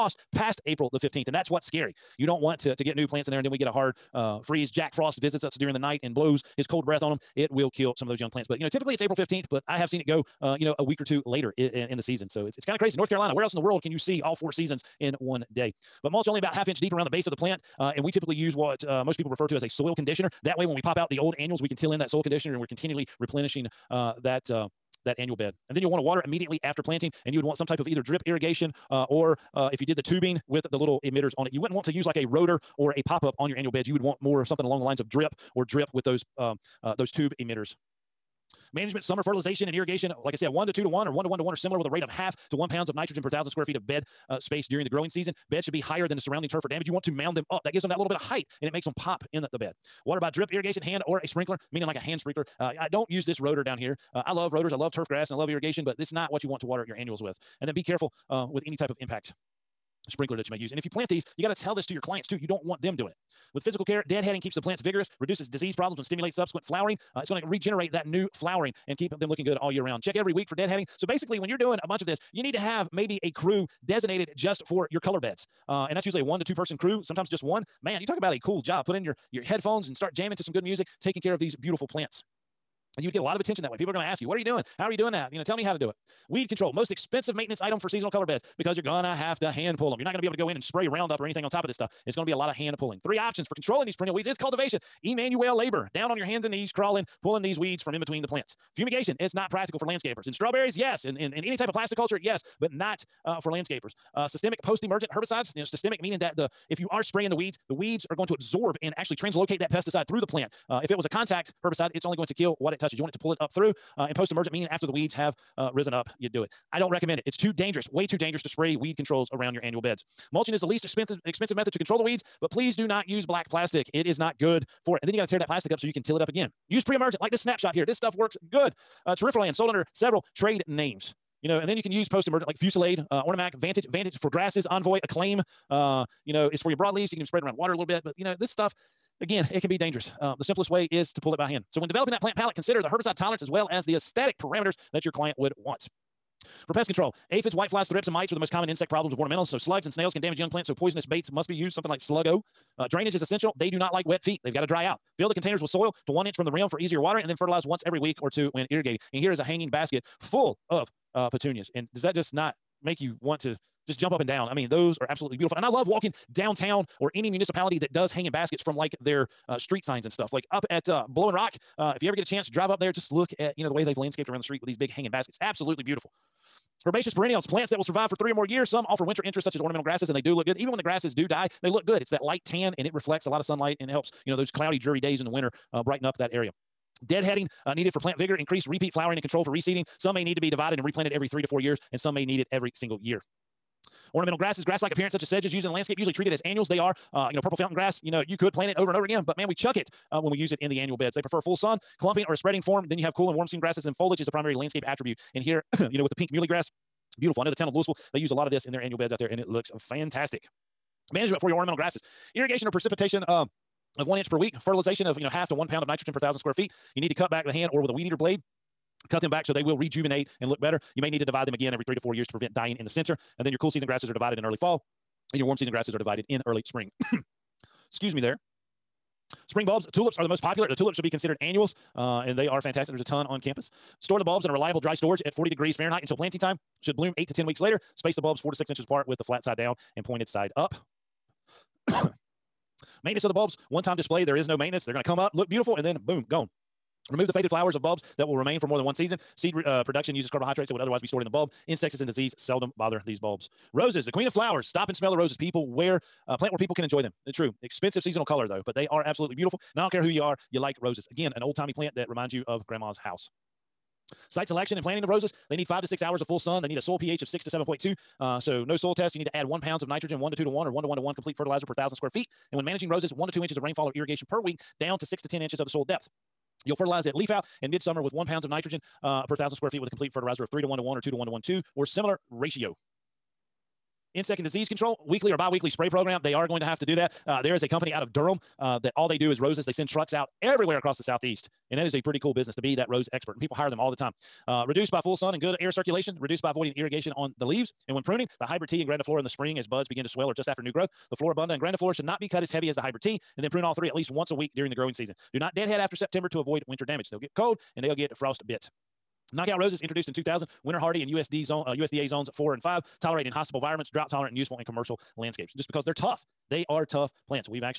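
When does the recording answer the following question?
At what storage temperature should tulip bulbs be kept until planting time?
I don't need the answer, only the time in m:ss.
3:55.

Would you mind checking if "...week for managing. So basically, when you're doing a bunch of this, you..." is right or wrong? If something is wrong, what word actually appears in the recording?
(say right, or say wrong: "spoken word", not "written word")
wrong: "deadheading", not "managing".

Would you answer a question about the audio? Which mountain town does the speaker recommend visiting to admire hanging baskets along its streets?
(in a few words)
Blowing Rock.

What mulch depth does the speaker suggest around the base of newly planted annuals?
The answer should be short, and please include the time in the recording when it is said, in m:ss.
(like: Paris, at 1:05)
half inch, at 0:16.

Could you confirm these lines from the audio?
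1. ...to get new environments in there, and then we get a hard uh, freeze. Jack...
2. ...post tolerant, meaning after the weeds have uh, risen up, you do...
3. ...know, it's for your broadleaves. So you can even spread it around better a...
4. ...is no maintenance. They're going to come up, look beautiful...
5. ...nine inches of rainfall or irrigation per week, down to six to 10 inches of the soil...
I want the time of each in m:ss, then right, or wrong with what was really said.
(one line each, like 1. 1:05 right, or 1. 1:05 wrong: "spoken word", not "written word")
1. 0:02 wrong: "plants", not "environments"
2. 1:54 wrong: "emergent", not "tolerant"
3. 2:16 wrong: "water", not "better"
4. 4:04 right
5. 4:33 wrong: "two", not "nine".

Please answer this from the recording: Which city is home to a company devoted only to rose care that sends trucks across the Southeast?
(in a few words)
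Durham.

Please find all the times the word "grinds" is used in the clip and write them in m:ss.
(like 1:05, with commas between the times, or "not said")
not said.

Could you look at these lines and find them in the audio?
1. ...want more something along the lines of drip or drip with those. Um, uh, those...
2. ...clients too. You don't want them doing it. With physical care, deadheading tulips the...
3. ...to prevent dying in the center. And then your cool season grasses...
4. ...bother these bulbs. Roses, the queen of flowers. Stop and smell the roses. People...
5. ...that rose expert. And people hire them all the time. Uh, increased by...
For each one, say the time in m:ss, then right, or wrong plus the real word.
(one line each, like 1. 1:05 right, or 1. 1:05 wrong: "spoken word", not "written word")
1. 0:34 right
2. 1:01 wrong: "keeps", not "tulips"
3. 3:42 right
4. 4:12 right
5. 4:52 wrong: "reduced", not "increased".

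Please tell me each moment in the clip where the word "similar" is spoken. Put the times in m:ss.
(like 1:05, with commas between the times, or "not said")
0:41, 4:41.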